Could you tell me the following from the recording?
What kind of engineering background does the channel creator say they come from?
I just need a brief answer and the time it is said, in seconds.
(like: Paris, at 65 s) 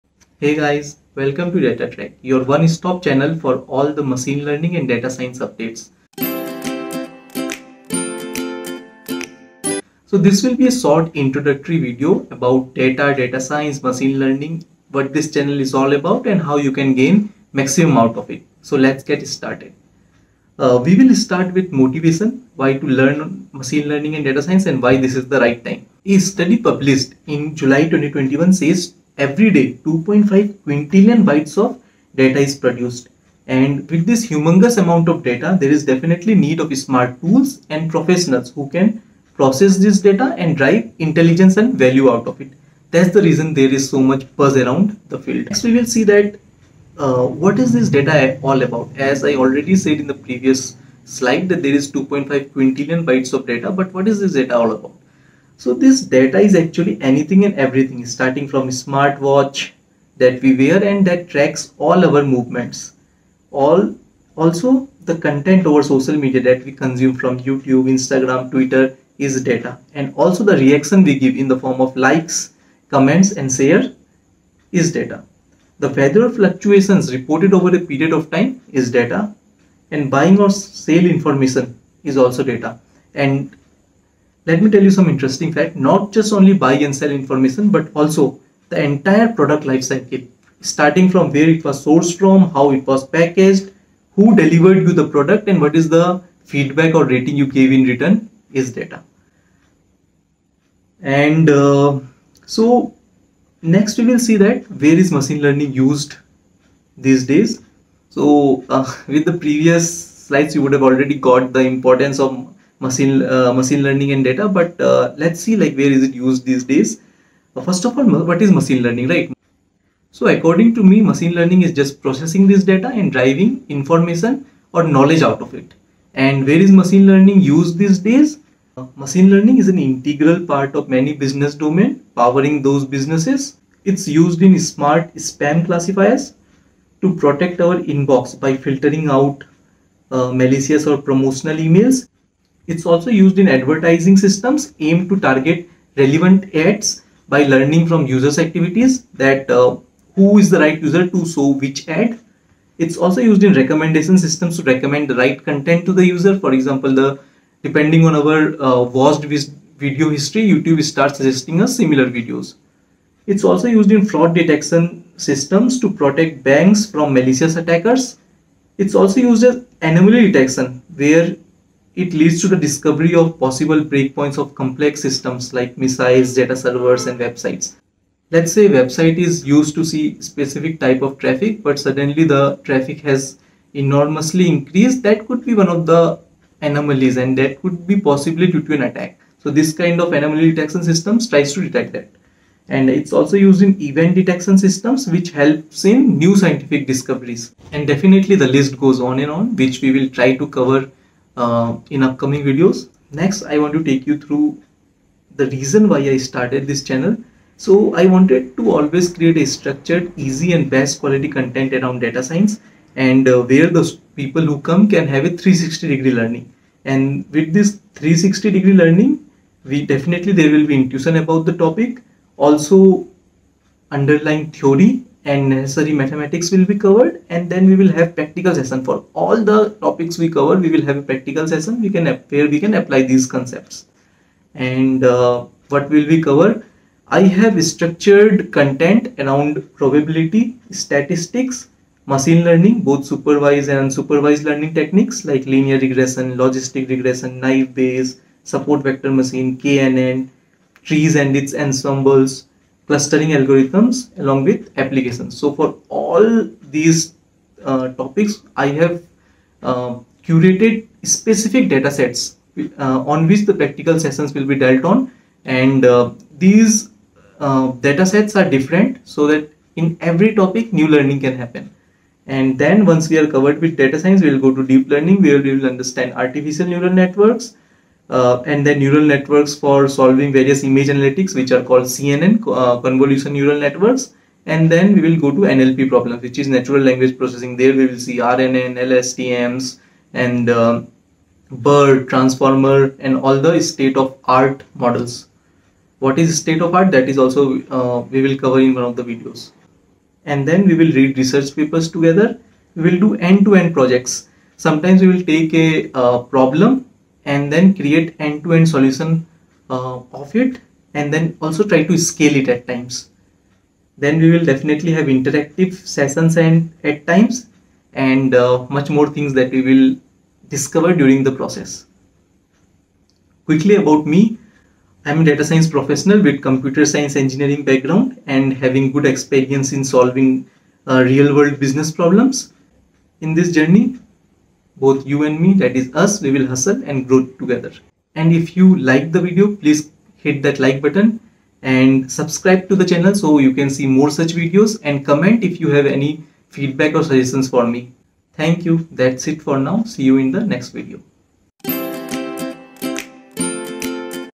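computer science, at 326 s.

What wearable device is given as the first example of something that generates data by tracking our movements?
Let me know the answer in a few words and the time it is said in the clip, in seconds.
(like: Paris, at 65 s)
smartwatch, at 58 s.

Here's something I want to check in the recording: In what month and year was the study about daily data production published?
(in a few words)
July 2021.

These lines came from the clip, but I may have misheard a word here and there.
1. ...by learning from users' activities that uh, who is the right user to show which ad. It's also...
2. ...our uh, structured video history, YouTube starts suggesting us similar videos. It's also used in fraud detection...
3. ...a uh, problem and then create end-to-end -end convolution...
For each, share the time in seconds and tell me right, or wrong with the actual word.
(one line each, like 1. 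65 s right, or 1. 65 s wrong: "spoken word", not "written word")
1. 147 s right
2. 158 s wrong: "watched", not "structured"
3. 305 s wrong: "solution", not "convolution".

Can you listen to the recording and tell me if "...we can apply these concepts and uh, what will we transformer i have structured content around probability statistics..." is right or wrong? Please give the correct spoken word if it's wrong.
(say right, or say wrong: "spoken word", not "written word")
wrong: "cover", not "transformer".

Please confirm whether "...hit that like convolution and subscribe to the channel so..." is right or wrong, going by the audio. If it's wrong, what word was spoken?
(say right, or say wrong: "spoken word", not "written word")
wrong: "button", not "convolution".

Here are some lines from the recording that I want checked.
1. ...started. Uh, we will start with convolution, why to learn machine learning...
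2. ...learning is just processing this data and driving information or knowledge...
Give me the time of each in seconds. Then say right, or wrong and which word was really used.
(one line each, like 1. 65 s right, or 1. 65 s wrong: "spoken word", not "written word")
1. 19 s wrong: "motivation", not "convolution"
2. 121 s right.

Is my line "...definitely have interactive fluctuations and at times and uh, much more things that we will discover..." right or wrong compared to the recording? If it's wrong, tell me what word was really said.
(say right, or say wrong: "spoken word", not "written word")
wrong: "sessions", not "fluctuations".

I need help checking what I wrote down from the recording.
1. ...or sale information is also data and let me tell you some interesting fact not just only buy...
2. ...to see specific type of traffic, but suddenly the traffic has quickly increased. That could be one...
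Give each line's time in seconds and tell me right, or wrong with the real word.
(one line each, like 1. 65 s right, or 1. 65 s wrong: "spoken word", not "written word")
1. 80 s right
2. 179 s wrong: "enormously", not "quickly".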